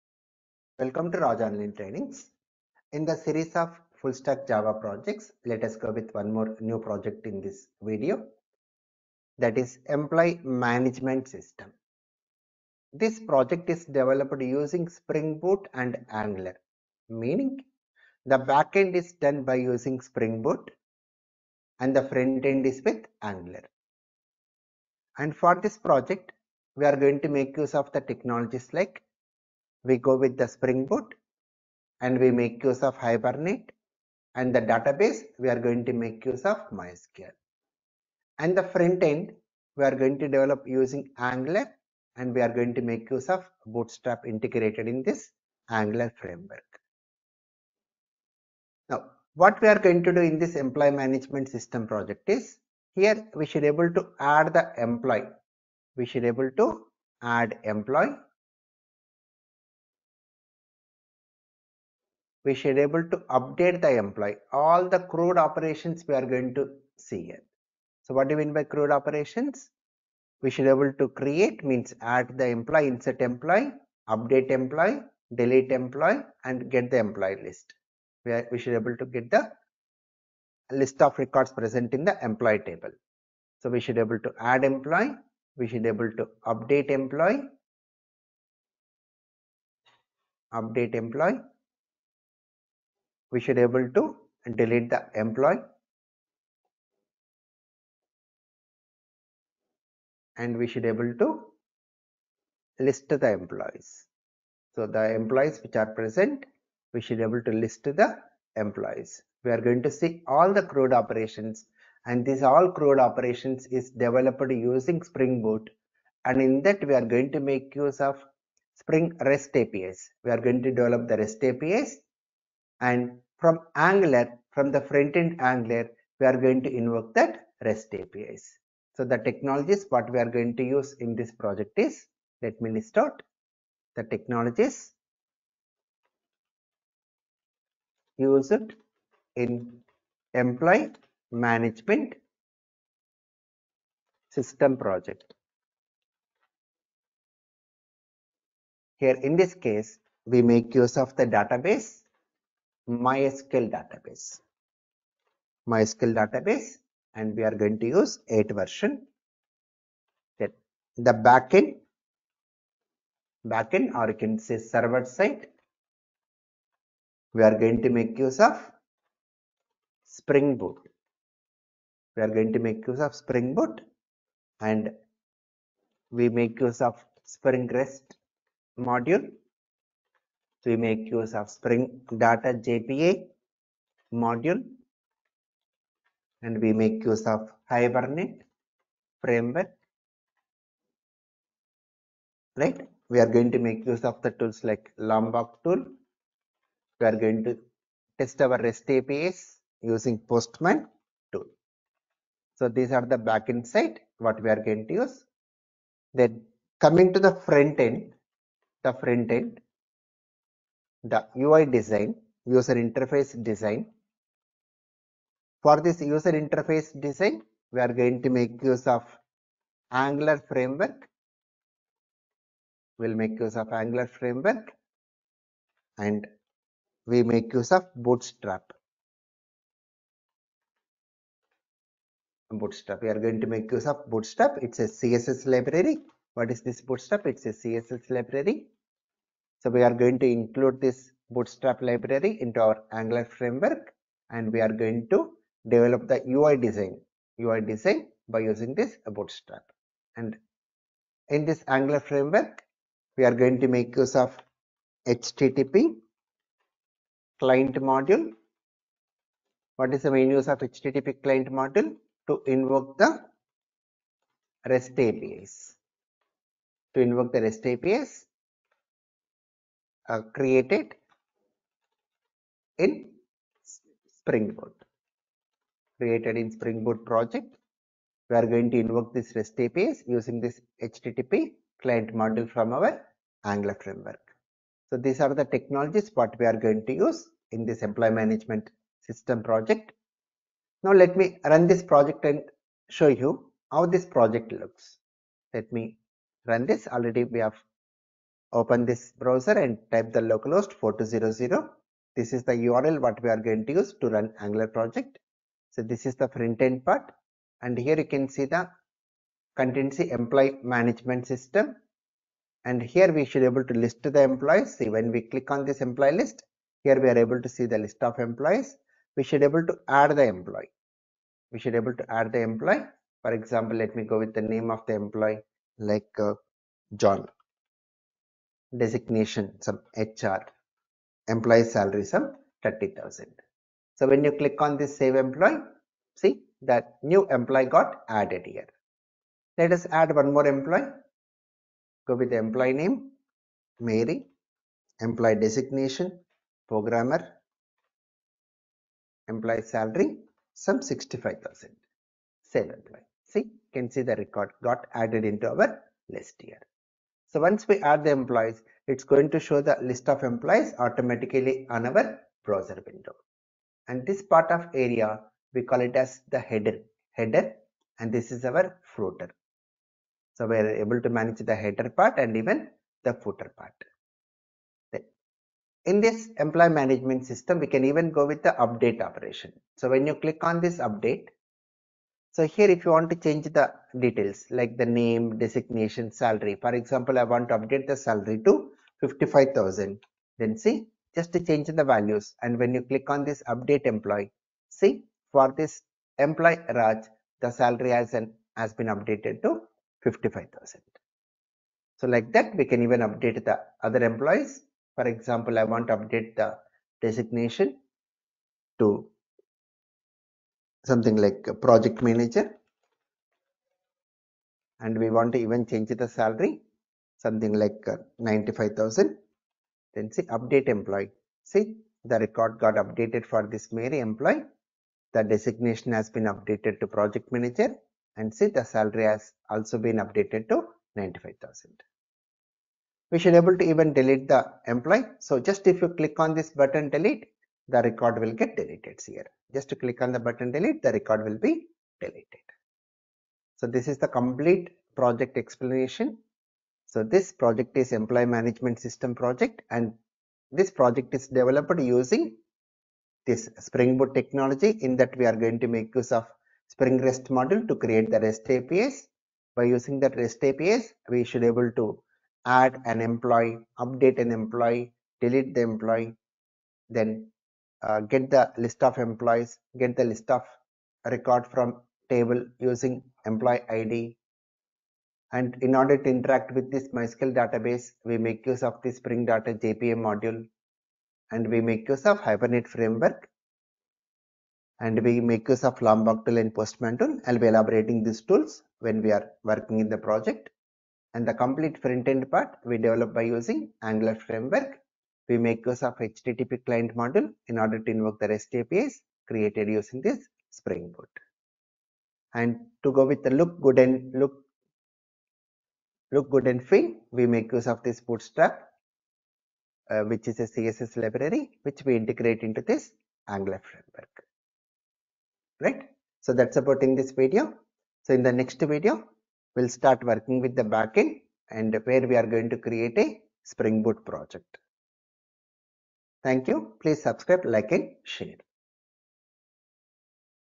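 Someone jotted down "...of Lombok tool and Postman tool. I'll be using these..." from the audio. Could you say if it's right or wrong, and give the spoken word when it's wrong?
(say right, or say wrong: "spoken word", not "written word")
wrong: "elaborating", not "using".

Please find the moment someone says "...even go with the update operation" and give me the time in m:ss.
6:17.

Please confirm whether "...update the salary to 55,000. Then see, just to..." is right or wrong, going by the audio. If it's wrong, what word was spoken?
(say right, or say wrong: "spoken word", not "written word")
right.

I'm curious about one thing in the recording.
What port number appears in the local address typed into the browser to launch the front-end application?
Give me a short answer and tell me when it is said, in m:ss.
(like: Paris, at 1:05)
4200, at 5:00.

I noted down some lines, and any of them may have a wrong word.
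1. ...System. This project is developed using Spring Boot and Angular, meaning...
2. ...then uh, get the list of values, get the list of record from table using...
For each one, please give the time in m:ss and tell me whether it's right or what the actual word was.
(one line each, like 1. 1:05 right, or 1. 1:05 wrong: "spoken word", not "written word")
1. 0:11 right
2. 7:46 wrong: "employees", not "values".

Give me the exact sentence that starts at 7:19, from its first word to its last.
Just to click on the button delete, the record will be deleted.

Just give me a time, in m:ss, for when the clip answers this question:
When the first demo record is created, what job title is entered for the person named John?
5:29.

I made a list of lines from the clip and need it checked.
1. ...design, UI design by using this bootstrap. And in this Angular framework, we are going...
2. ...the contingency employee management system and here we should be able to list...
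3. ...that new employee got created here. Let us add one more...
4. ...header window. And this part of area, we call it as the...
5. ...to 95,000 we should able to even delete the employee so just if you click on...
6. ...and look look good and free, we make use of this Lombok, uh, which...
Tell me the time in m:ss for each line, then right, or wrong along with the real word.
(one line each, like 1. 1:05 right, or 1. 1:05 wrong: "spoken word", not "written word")
1. 4:06 right
2. 5:08 right
3. 5:36 wrong: "added", not "created"
4. 6:02 wrong: "browser", not "header"
5. 7:10 right
6. 8:23 wrong: "Bootstrap", not "Lombok".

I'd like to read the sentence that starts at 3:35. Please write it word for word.
For this user interface design, we are going to make use of Angular framework.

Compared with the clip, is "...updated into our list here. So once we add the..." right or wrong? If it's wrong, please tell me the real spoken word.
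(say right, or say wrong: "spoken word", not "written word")
wrong: "added", not "updated".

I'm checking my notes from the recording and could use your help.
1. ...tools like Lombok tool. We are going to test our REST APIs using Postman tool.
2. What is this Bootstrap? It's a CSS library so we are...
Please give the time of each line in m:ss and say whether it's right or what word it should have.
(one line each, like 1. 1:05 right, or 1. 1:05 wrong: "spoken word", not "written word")
1. 3:14 right
2. 3:56 right.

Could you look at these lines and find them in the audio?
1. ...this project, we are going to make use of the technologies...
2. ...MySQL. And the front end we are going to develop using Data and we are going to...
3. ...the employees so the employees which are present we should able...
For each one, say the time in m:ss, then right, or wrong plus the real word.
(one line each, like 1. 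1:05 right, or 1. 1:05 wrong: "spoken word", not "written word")
1. 0:25 right
2. 0:36 wrong: "Angular", not "Data"
3. 1:43 right.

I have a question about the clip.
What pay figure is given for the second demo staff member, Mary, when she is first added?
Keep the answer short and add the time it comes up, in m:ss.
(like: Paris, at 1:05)
65,000, at 5:50.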